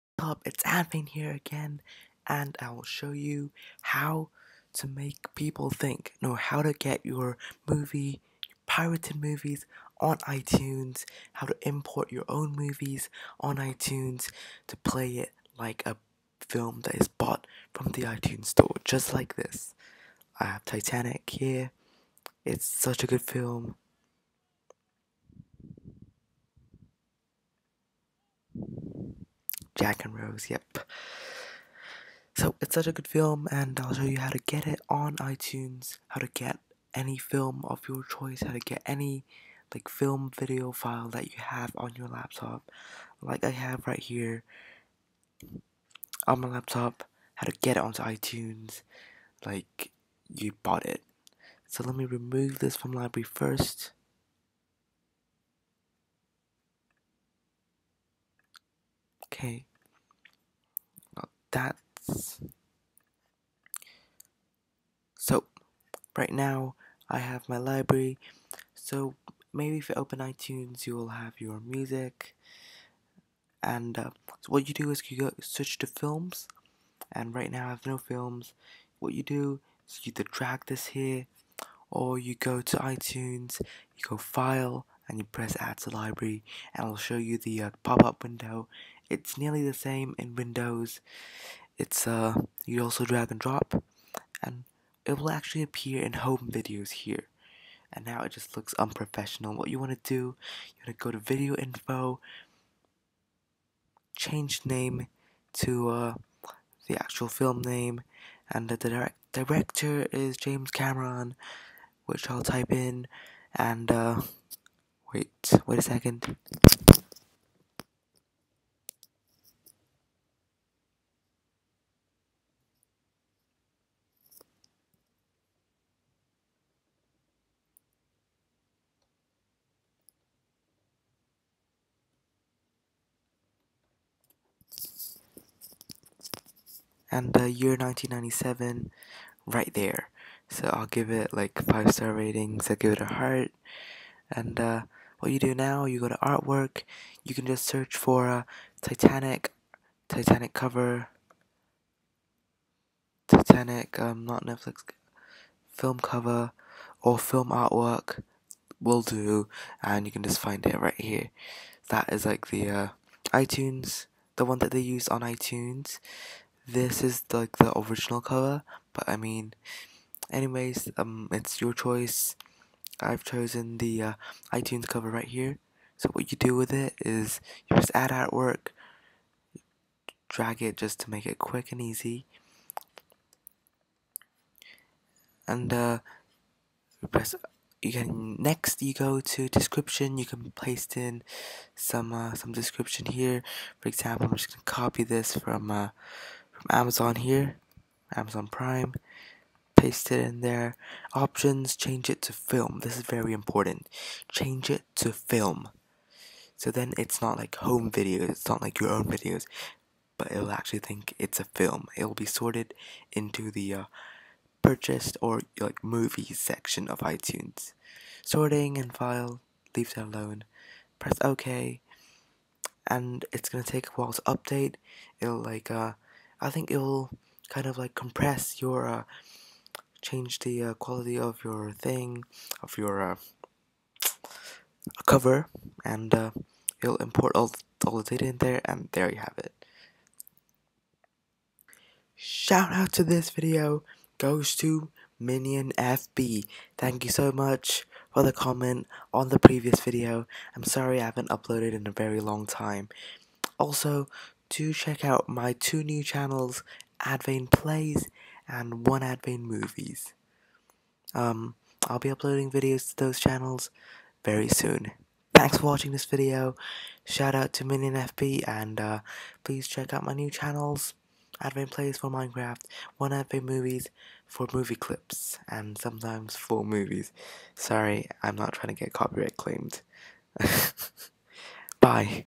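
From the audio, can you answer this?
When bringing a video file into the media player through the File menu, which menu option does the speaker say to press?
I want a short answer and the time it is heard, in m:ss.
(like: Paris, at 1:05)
Add to library, at 1:25.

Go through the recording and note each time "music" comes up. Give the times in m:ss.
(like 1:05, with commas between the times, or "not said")
1:11.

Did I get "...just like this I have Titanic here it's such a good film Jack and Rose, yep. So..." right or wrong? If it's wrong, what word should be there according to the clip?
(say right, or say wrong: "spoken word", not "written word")
right.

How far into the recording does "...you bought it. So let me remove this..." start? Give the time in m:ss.
0:50.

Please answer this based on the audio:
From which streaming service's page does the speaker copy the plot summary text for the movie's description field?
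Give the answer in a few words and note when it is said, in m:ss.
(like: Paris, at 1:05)
Amazon Prime, at 3:18.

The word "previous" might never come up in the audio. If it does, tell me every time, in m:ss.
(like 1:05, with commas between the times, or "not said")
4:09.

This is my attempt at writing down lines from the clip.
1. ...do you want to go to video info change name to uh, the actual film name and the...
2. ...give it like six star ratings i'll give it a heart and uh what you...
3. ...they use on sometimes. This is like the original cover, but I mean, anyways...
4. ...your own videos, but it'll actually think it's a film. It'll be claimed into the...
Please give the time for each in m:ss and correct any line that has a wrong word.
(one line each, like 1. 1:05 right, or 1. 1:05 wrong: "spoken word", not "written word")
1. 1:40 right
2. 2:20 wrong: "five", not "six"
3. 2:44 wrong: "iTunes", not "sometimes"
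4. 3:28 wrong: "sorted", not "claimed".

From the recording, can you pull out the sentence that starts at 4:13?
Also, do check out my two new channels, Advane Plays and one Advane movies.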